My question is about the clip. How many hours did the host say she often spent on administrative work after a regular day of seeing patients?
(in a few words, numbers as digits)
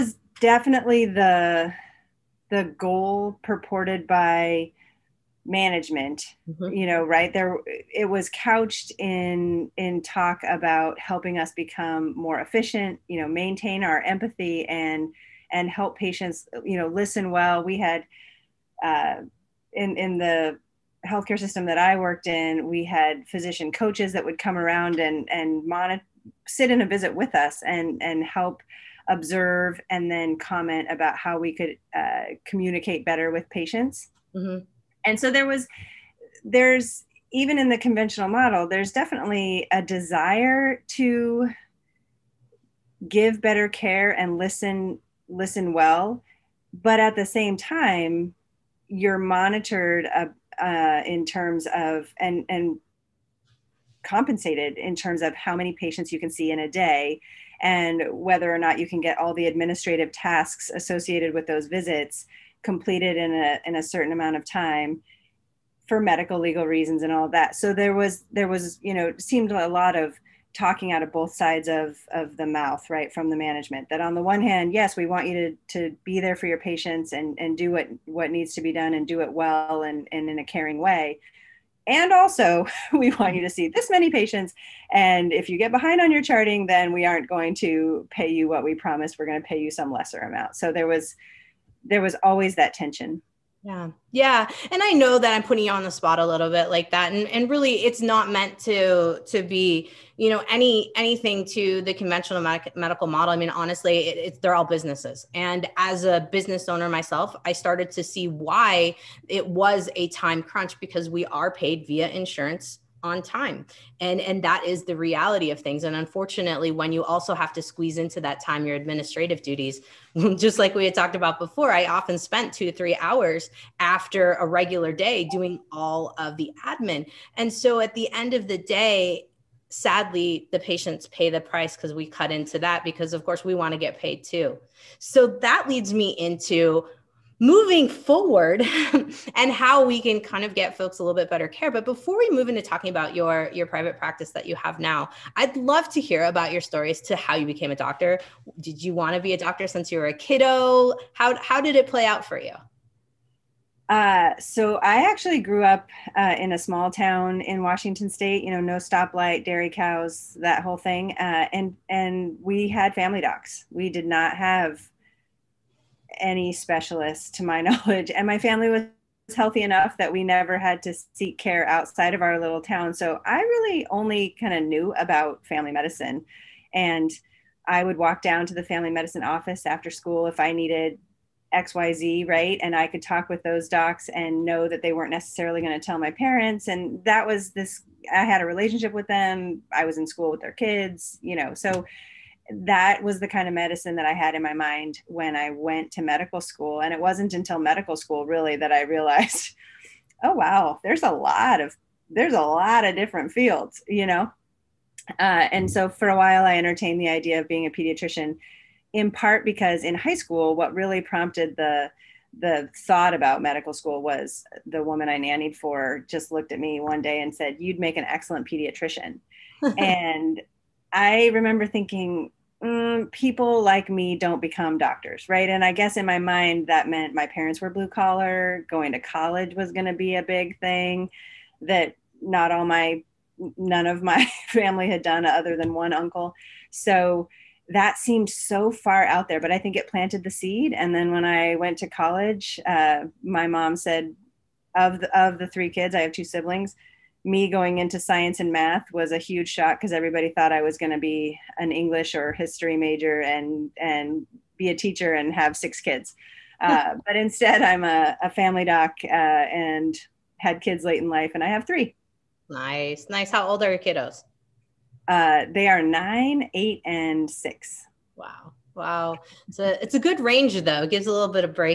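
2 to 3 hours.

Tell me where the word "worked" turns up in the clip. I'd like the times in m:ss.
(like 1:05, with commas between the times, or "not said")
0:21.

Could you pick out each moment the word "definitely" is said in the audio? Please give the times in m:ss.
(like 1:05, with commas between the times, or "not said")
0:00, 0:38.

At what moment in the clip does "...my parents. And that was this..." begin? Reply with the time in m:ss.
3:05.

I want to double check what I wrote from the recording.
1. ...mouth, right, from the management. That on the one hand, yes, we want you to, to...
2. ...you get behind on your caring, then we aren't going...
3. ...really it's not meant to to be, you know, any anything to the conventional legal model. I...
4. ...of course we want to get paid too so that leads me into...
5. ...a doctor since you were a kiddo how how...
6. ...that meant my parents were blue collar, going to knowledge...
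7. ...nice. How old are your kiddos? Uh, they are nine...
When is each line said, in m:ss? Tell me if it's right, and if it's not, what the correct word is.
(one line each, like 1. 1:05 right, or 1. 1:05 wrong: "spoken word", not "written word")
1. 1:12 right
2. 1:25 wrong: "charting", not "caring"
3. 1:37 wrong: "medical", not "legal"
4. 2:13 right
5. 2:29 right
6. 3:46 wrong: "college", not "knowledge"
7. 4:23 right.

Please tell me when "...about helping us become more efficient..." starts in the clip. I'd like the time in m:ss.
0:10.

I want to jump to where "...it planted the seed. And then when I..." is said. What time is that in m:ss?
3:59.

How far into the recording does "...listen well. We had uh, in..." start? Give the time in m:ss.
0:16.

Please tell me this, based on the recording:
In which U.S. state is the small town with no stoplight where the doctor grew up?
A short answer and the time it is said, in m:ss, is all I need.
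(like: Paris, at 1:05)
Washington, at 2:37.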